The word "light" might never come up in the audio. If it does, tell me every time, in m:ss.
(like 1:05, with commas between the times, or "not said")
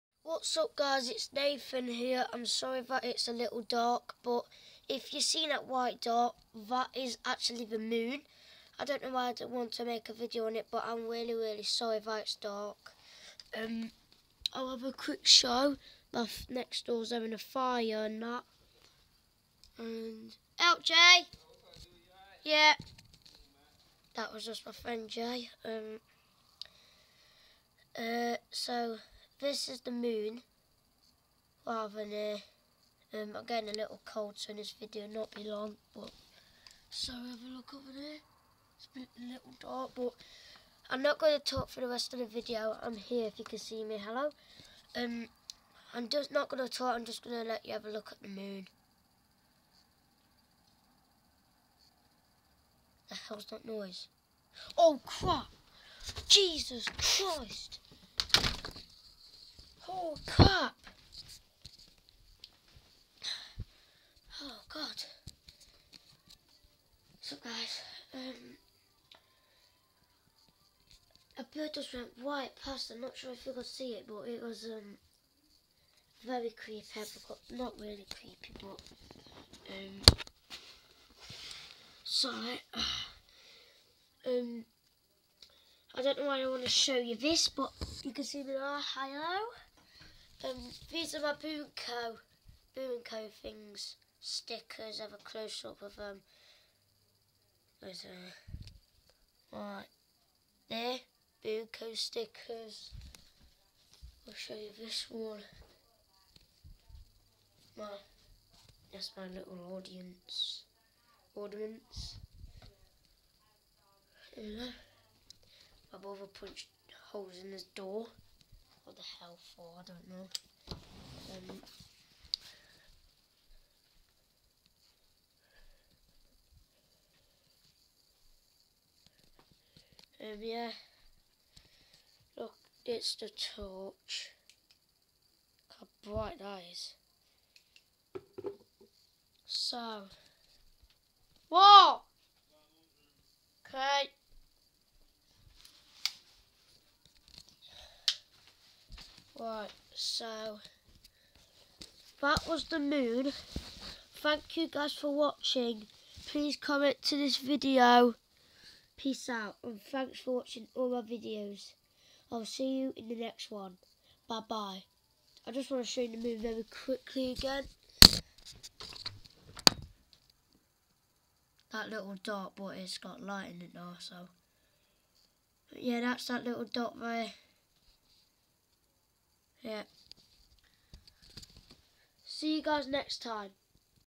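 2:53.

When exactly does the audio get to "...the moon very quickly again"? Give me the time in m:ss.
2:46.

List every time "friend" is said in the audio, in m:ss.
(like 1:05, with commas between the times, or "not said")
0:24.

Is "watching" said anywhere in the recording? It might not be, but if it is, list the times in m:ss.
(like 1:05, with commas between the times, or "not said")
2:35, 2:40.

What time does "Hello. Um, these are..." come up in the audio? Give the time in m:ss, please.
1:28.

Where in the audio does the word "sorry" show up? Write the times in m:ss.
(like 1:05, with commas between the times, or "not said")
0:02, 0:11, 1:22.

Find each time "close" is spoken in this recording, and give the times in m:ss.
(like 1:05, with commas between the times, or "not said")
1:35.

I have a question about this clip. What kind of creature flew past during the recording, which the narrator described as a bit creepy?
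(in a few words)
A bird.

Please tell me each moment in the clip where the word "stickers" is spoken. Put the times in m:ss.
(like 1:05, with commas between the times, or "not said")
1:34, 1:41.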